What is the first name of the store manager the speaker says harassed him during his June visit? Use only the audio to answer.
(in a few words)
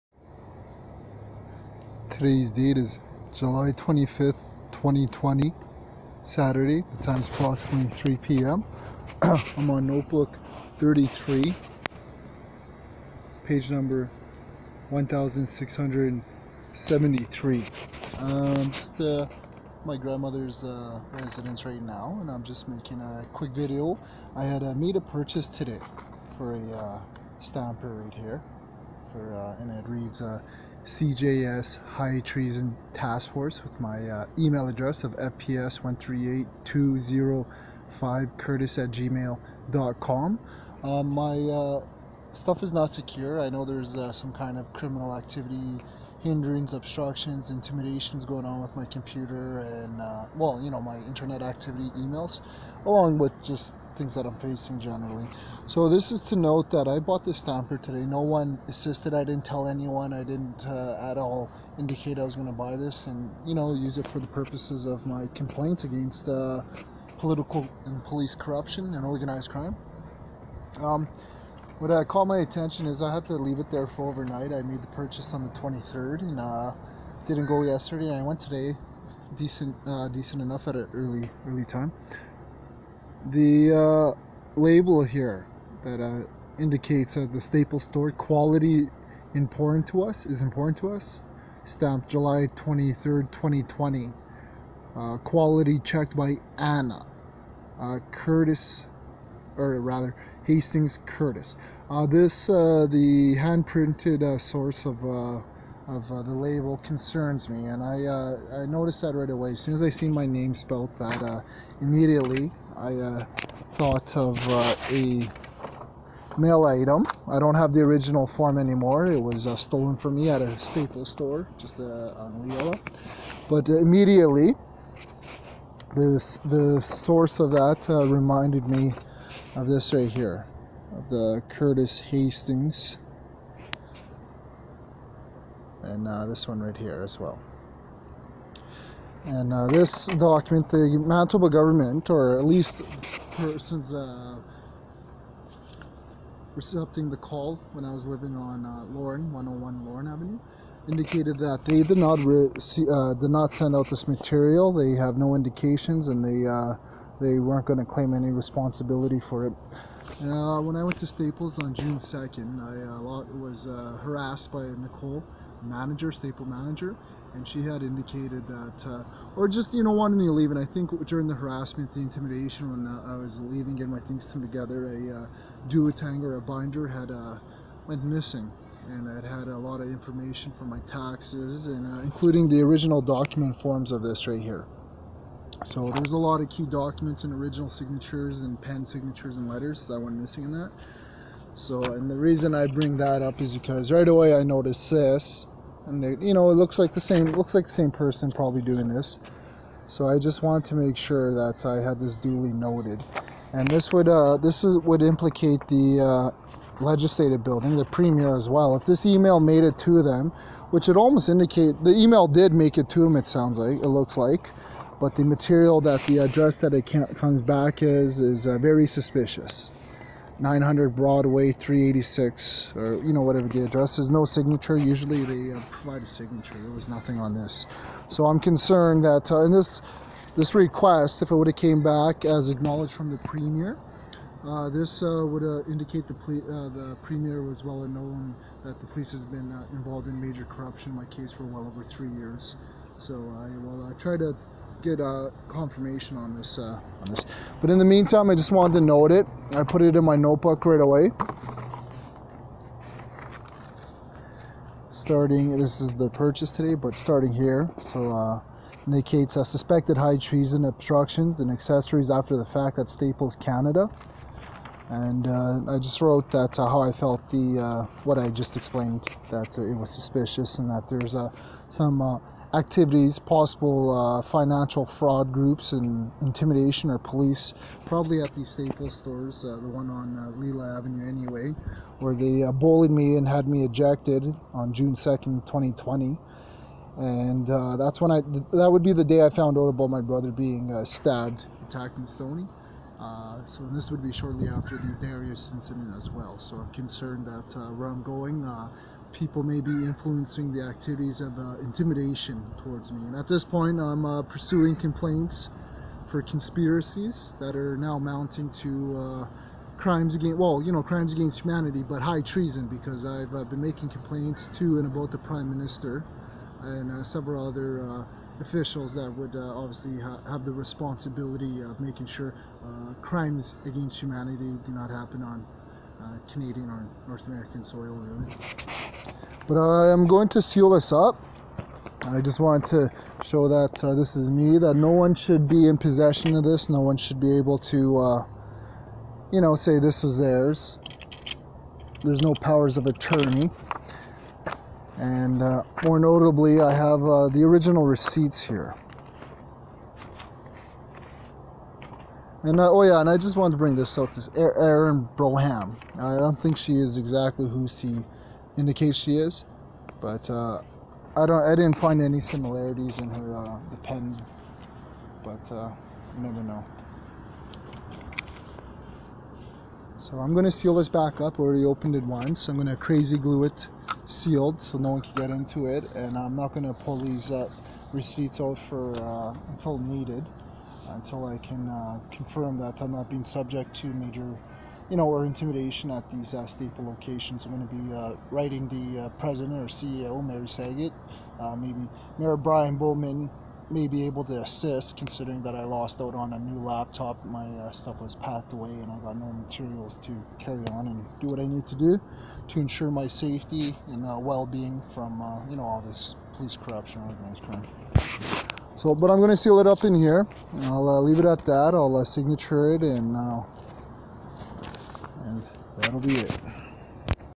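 Nicole.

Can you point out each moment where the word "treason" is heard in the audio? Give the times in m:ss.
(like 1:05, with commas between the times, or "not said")
0:32, 4:20, 5:12.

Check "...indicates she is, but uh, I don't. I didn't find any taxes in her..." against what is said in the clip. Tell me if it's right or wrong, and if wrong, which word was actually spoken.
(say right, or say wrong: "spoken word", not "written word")
wrong: "similarities", not "taxes".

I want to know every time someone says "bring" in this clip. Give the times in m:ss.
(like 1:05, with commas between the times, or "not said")
3:12, 5:53.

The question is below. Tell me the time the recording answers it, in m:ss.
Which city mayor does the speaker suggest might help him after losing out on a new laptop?
6:32.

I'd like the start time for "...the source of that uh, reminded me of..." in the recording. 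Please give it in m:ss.
2:06.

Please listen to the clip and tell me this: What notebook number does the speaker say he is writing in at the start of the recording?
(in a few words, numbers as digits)
33.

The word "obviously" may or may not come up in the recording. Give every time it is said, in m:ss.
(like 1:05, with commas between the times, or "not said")
5:19.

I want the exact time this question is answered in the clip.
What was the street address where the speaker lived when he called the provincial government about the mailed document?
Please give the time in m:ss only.
2:29.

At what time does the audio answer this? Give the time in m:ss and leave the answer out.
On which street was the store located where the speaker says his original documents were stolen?
2:02.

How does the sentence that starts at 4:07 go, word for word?
But in the meantime, I just wanted to note it.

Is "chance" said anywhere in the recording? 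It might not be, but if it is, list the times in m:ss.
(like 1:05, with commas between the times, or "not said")
not said.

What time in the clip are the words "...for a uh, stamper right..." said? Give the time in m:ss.
0:26.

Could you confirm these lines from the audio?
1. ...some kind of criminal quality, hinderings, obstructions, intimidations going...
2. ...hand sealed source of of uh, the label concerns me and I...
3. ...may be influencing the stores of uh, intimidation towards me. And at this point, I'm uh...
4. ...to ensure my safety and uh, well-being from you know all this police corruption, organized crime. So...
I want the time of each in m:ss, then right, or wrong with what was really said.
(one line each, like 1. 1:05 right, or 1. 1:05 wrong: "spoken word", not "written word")
1. 0:44 wrong: "activity", not "quality"
2. 1:43 wrong: "printed", not "sealed"
3. 4:59 wrong: "activities", not "stores"
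4. 6:42 right.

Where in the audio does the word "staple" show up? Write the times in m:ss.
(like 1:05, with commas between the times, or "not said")
1:27, 2:00, 2:41, 2:46, 4:22, 4:38, 6:26.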